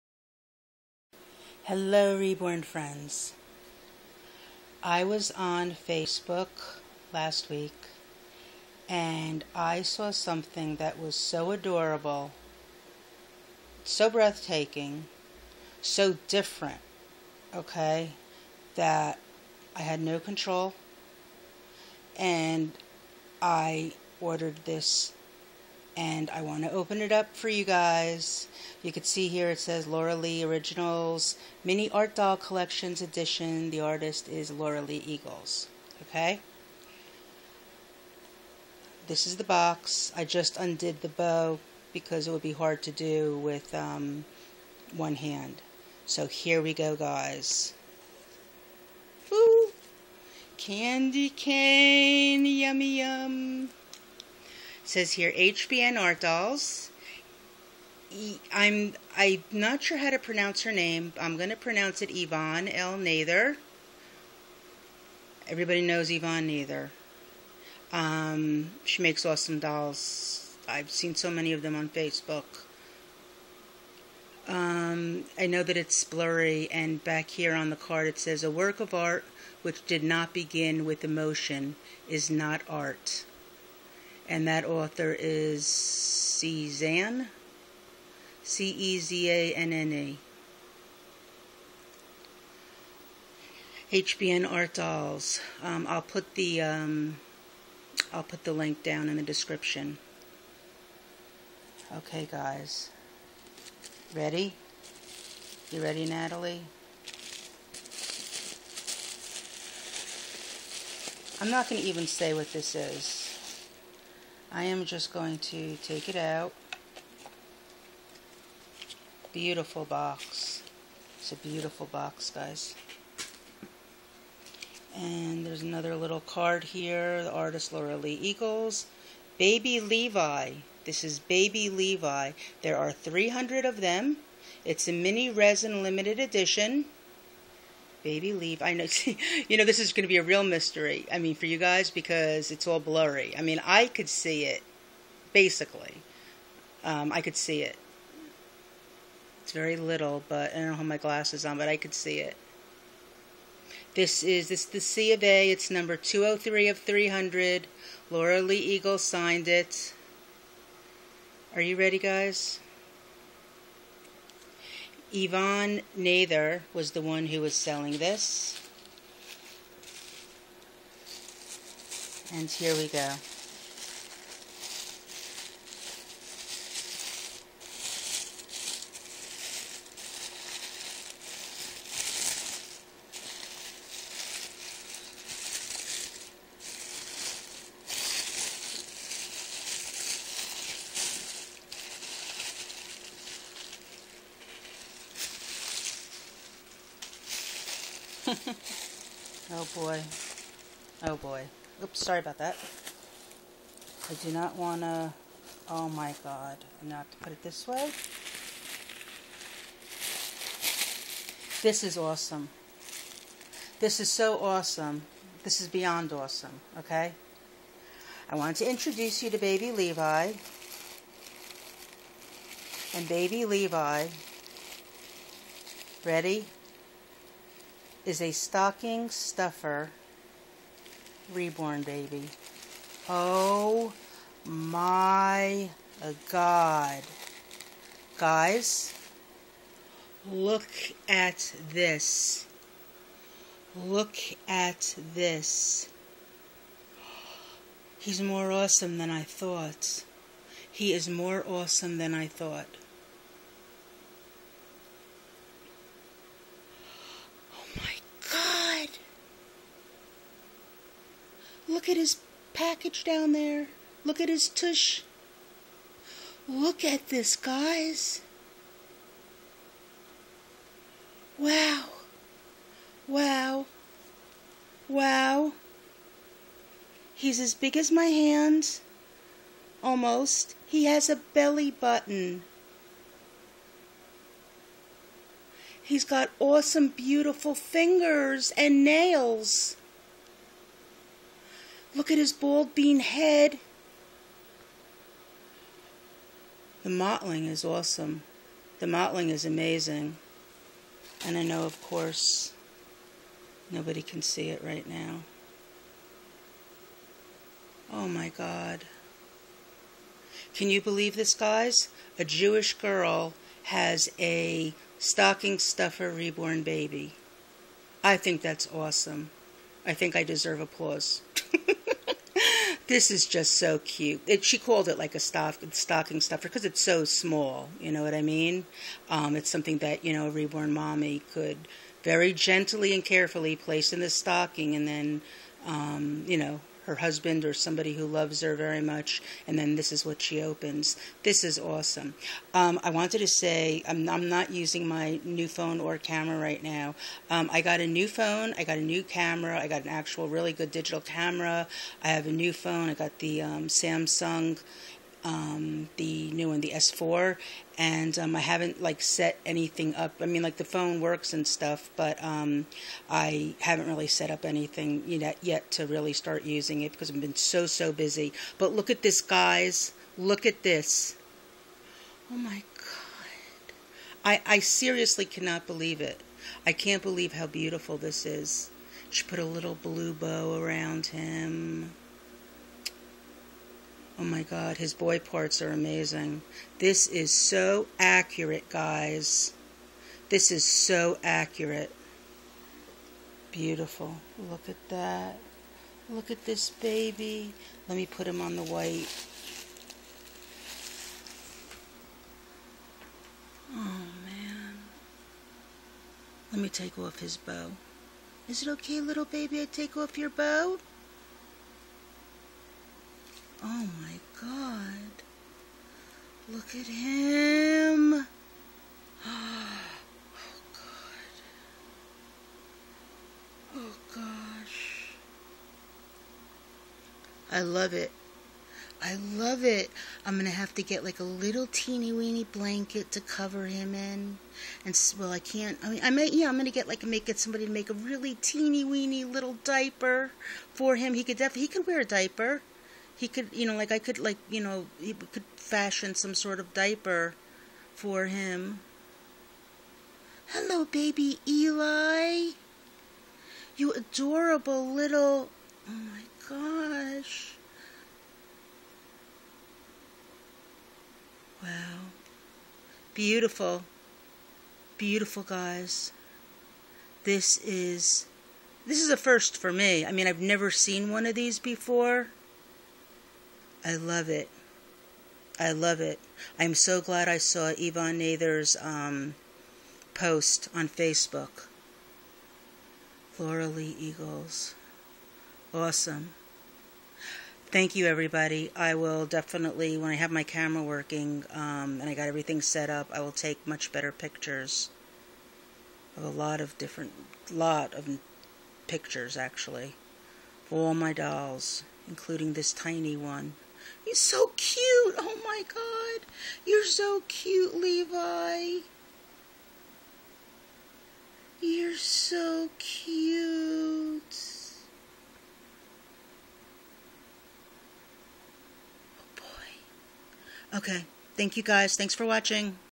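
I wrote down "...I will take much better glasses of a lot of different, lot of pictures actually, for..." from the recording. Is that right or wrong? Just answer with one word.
wrong.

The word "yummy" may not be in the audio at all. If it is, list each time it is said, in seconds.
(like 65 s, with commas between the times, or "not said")
52 s.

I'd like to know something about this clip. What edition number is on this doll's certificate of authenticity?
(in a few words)
203.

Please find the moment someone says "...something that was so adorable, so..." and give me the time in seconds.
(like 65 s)
10 s.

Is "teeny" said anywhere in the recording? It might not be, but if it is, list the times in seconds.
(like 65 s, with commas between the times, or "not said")
431 s, 438 s.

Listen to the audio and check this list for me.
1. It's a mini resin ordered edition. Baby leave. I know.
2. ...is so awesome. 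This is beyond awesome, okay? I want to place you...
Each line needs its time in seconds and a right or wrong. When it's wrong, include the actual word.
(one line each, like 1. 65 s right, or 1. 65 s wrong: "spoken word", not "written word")
1. 134 s wrong: "limited", not "ordered"
2. 213 s wrong: "introduce", not "place".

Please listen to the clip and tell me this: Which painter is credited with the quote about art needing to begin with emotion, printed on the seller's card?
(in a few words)
Cezanne.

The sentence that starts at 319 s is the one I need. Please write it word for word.
I think I deserve applause this is just so cute.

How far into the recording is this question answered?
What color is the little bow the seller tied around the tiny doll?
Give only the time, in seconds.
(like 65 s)
379 s.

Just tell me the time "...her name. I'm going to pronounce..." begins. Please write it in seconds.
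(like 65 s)
60 s.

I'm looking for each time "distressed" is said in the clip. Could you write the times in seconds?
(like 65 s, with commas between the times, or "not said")
not said.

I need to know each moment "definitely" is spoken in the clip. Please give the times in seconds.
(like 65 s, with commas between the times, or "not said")
441 s, 489 s.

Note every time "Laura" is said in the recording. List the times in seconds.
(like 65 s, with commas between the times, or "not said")
29 s, 34 s, 127 s, 158 s, 483 s.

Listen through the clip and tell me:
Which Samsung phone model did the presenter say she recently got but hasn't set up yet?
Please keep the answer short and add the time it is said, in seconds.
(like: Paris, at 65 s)
S4, at 356 s.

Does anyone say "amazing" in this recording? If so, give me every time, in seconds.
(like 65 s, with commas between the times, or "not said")
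299 s, 385 s.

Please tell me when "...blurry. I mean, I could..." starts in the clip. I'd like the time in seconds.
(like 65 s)
142 s.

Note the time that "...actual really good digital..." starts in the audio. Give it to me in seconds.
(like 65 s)
349 s.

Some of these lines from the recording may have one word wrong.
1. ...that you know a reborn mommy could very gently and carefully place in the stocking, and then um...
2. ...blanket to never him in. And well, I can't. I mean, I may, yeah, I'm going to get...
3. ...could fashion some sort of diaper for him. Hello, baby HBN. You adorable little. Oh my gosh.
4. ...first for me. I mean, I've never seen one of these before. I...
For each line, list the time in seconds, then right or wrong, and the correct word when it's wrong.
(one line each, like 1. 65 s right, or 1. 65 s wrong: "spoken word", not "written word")
1. 329 s right
2. 432 s wrong: "cover", not "never"
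3. 445 s wrong: "Eli", not "HBN"
4. 469 s right.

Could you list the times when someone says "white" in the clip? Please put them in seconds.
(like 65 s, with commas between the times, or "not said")
398 s.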